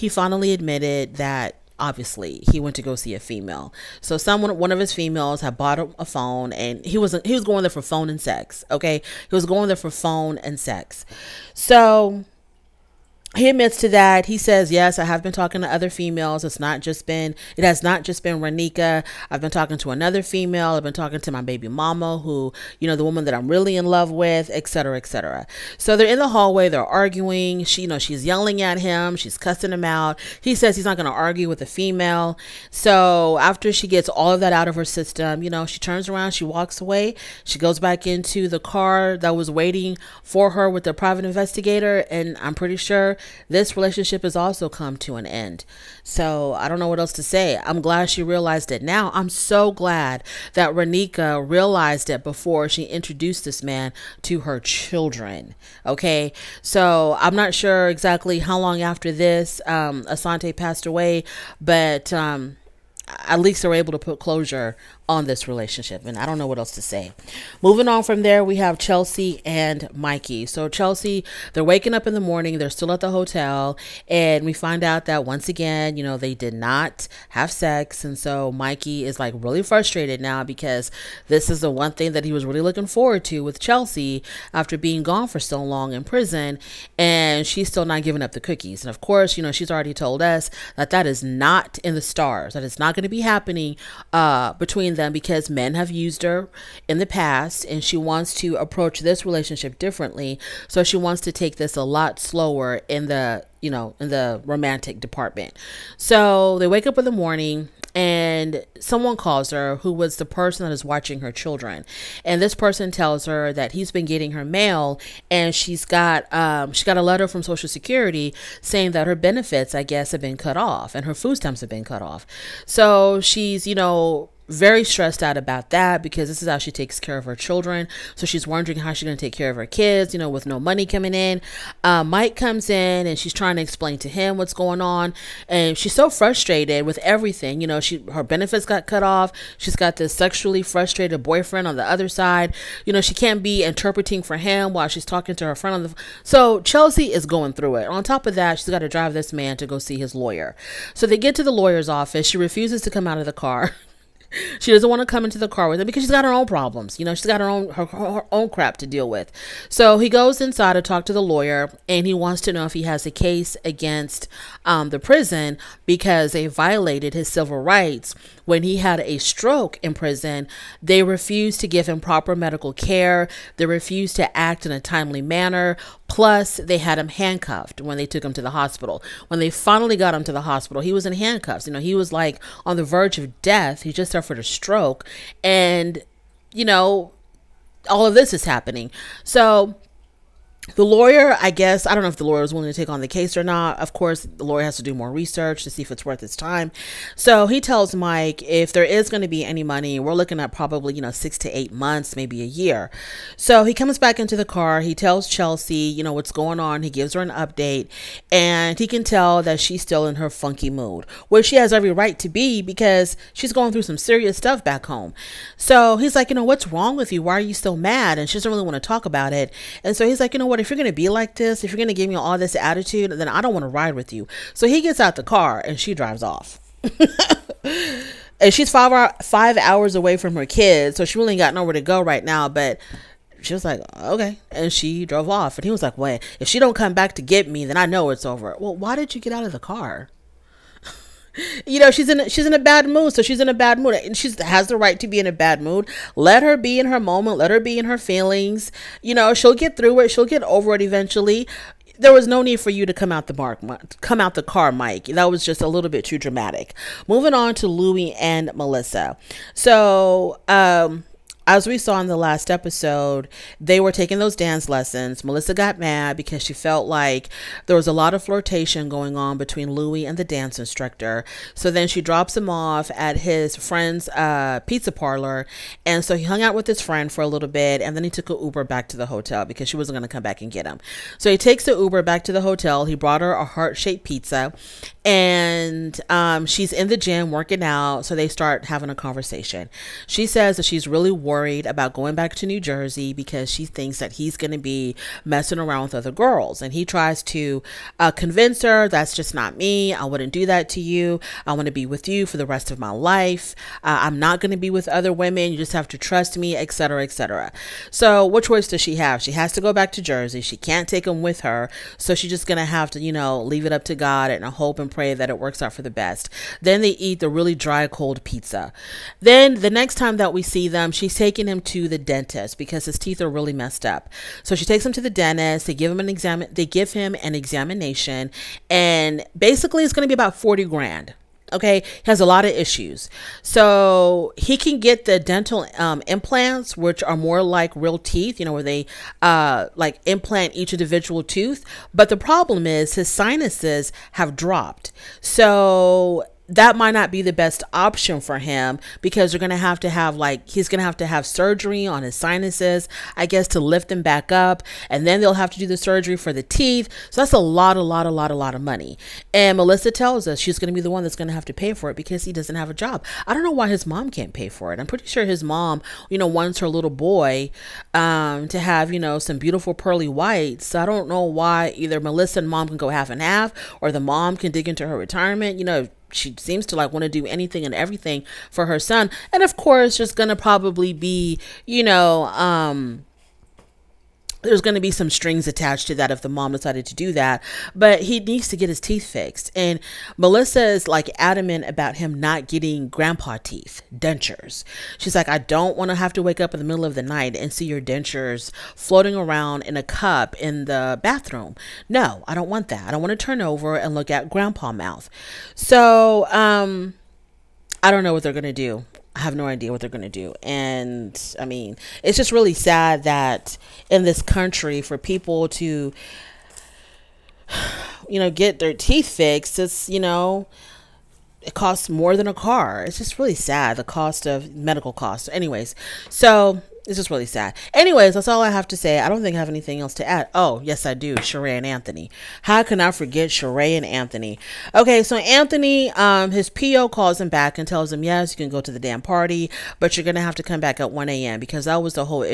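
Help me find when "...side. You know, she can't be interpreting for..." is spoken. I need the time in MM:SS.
02:22.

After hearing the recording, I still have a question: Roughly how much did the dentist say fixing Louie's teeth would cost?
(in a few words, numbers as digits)
40 grand.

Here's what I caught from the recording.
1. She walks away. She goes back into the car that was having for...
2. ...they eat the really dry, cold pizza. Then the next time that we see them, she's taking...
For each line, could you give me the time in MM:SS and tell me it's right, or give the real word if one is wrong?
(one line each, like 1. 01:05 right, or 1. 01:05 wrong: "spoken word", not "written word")
1. 00:36 wrong: "waiting", not "having"
2. 05:16 right.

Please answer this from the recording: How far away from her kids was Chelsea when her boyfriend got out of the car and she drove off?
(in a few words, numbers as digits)
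5 hours.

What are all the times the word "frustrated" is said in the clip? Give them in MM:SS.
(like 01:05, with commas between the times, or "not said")
01:19, 02:16, 02:20.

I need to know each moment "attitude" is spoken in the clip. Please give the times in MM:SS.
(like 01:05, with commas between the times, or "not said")
03:42.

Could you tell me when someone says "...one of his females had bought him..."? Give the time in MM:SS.
00:04.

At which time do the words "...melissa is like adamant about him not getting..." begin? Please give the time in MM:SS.
06:30.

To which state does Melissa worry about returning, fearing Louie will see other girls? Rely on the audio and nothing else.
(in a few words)
New Jersey.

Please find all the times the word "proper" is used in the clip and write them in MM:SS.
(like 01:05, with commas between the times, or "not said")
02:52.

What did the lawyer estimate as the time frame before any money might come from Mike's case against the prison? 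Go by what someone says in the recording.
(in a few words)
6 to 8 months.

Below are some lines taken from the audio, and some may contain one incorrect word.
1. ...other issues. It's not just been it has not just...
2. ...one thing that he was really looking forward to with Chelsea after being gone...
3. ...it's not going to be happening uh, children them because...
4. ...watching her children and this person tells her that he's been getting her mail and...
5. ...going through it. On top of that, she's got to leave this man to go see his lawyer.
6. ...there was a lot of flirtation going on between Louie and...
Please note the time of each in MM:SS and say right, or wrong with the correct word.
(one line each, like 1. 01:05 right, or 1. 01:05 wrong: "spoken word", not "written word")
1. 00:15 wrong: "females", not "issues"
2. 01:21 right
3. 01:32 wrong: "between", not "children"
4. 01:50 right
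5. 02:27 wrong: "drive", not "leave"
6. 04:27 right.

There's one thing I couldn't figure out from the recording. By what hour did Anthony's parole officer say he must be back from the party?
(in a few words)
1 a.m.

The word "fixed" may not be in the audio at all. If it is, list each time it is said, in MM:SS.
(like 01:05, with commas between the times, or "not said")
06:29, 06:59.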